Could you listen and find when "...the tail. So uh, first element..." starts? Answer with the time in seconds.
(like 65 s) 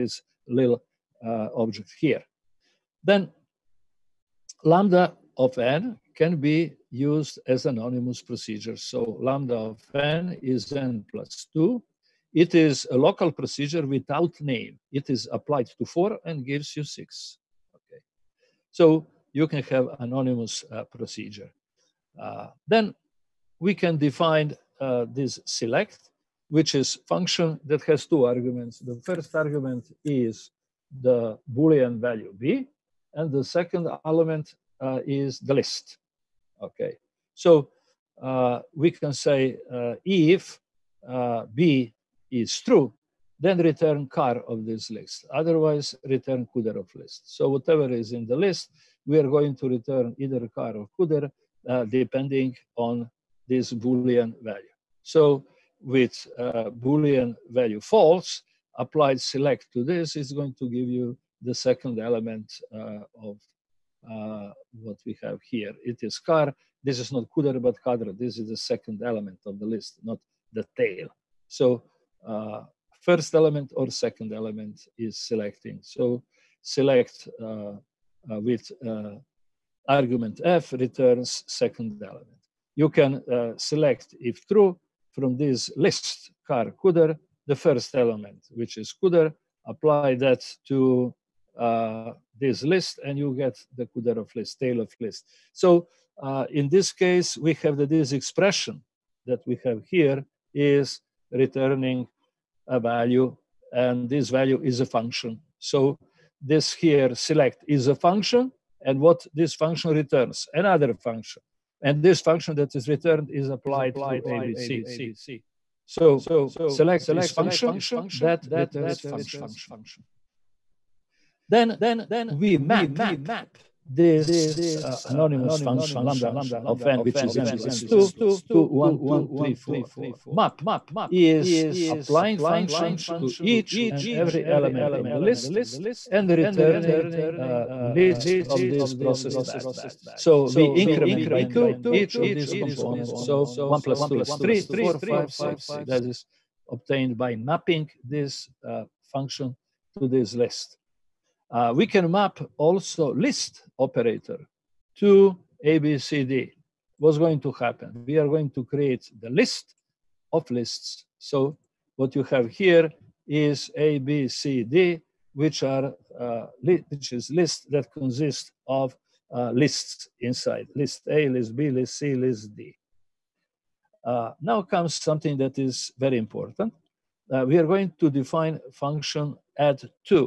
70 s.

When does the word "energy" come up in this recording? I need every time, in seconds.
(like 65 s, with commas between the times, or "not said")
not said.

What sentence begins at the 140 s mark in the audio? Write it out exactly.
So we increment by two each of these components.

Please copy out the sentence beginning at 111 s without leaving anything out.
And this function that is returned is applied to ABC.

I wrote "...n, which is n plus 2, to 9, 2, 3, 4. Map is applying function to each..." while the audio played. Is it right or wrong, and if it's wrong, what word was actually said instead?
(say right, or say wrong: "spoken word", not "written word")
wrong: "1", not "9".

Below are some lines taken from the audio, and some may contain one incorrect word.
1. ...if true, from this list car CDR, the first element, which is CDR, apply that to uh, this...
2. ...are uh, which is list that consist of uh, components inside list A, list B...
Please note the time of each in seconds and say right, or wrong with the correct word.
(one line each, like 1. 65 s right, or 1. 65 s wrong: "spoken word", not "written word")
1. 84 s right
2. 165 s wrong: "lists", not "components".